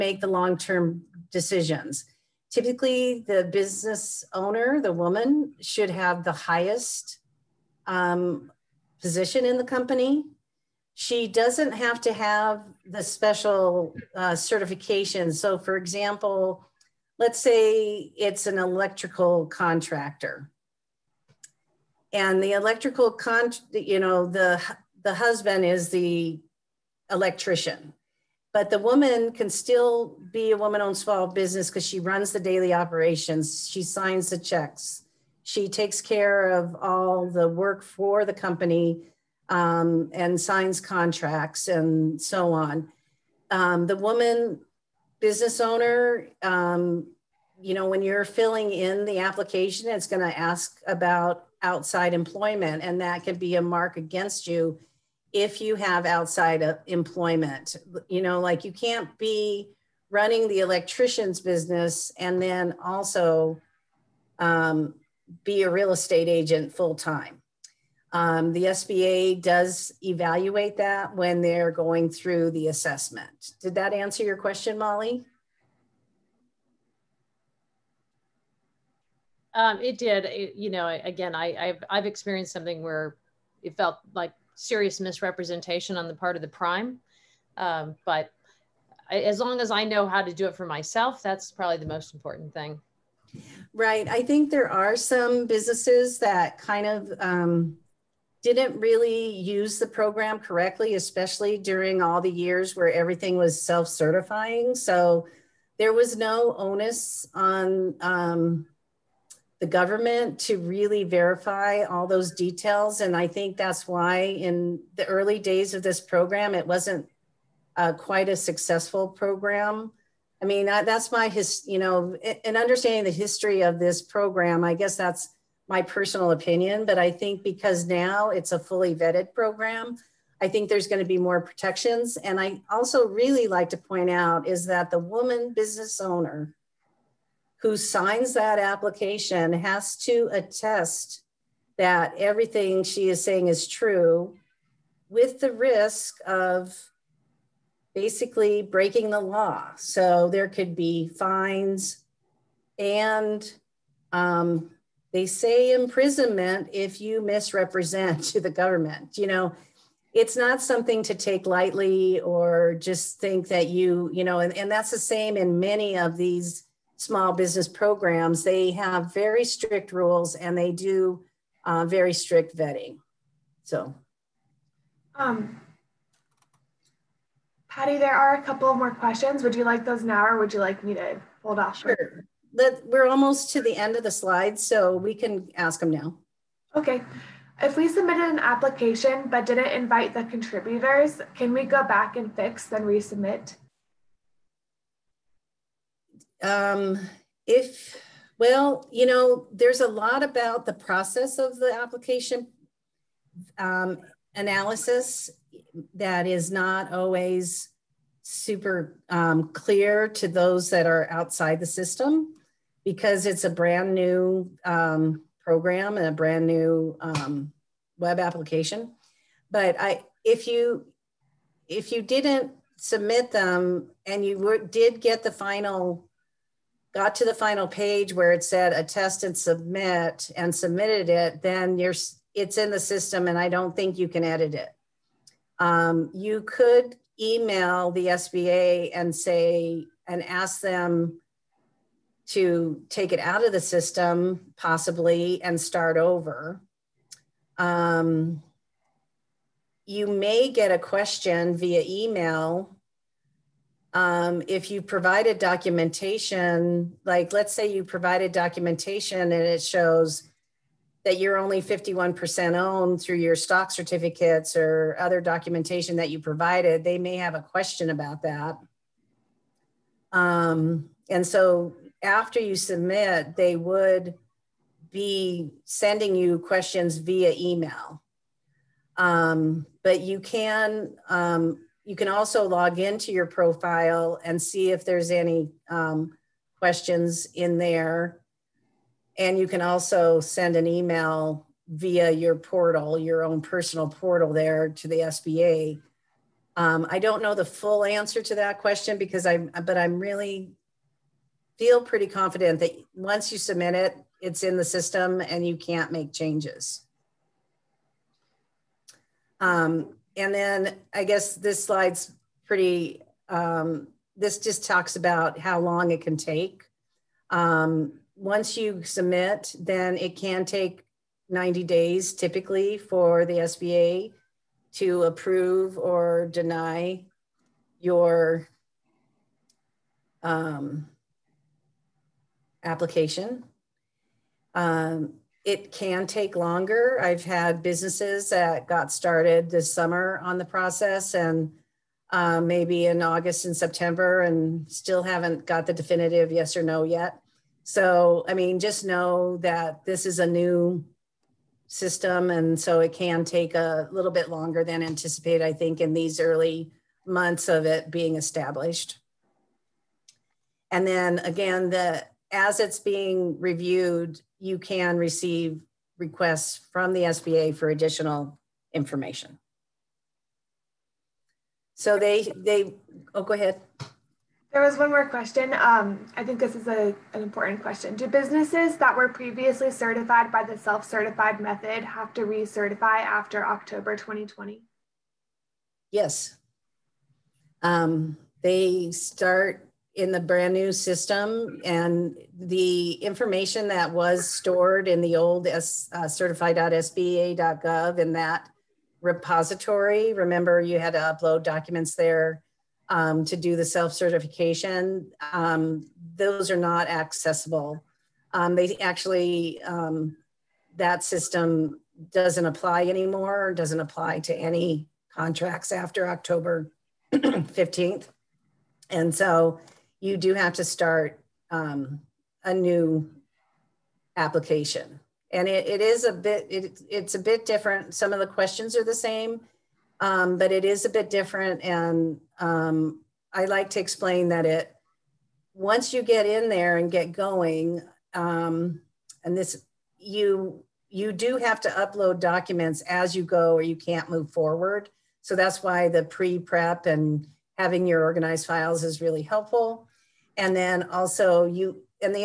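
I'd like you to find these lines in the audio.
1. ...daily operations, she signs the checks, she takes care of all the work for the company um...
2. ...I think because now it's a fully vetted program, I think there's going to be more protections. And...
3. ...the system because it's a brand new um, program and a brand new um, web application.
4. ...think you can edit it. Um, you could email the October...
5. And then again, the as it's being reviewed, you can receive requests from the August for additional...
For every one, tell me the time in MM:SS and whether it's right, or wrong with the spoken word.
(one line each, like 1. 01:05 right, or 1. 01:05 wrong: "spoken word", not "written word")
1. 00:32 right
2. 02:06 right
3. 03:31 right
4. 03:53 wrong: "SBA", not "October"
5. 06:00 wrong: "SBA", not "August".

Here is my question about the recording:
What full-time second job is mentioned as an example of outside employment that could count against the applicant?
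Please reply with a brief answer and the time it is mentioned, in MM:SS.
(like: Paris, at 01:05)
Real estate agent, at 01:05.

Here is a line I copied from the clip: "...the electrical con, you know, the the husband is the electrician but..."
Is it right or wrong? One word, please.
right.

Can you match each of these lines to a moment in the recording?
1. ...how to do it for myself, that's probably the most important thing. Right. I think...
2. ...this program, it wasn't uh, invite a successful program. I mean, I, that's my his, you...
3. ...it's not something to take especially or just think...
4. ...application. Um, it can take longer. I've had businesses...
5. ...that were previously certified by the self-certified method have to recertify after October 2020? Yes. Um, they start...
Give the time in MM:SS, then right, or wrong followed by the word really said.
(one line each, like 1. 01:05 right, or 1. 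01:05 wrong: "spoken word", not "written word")
1. 01:30 right
2. 01:55 wrong: "quite", not "invite"
3. 02:40 wrong: "lightly", not "especially"
4. 05:32 right
5. 06:18 right.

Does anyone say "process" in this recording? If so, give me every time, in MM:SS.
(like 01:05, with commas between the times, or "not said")
03:20, 05:40.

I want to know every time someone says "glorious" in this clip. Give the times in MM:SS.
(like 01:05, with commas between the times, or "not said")
not said.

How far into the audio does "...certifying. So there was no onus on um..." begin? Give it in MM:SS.
01:43.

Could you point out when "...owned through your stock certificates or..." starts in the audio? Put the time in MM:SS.
04:22.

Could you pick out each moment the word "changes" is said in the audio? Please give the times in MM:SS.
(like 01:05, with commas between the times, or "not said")
05:06.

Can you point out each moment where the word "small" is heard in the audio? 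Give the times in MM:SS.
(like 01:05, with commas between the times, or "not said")
00:30, 02:46.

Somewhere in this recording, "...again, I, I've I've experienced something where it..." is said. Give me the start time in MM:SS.
01:21.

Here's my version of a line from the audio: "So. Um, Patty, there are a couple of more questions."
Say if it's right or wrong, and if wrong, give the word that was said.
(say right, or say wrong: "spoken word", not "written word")
right.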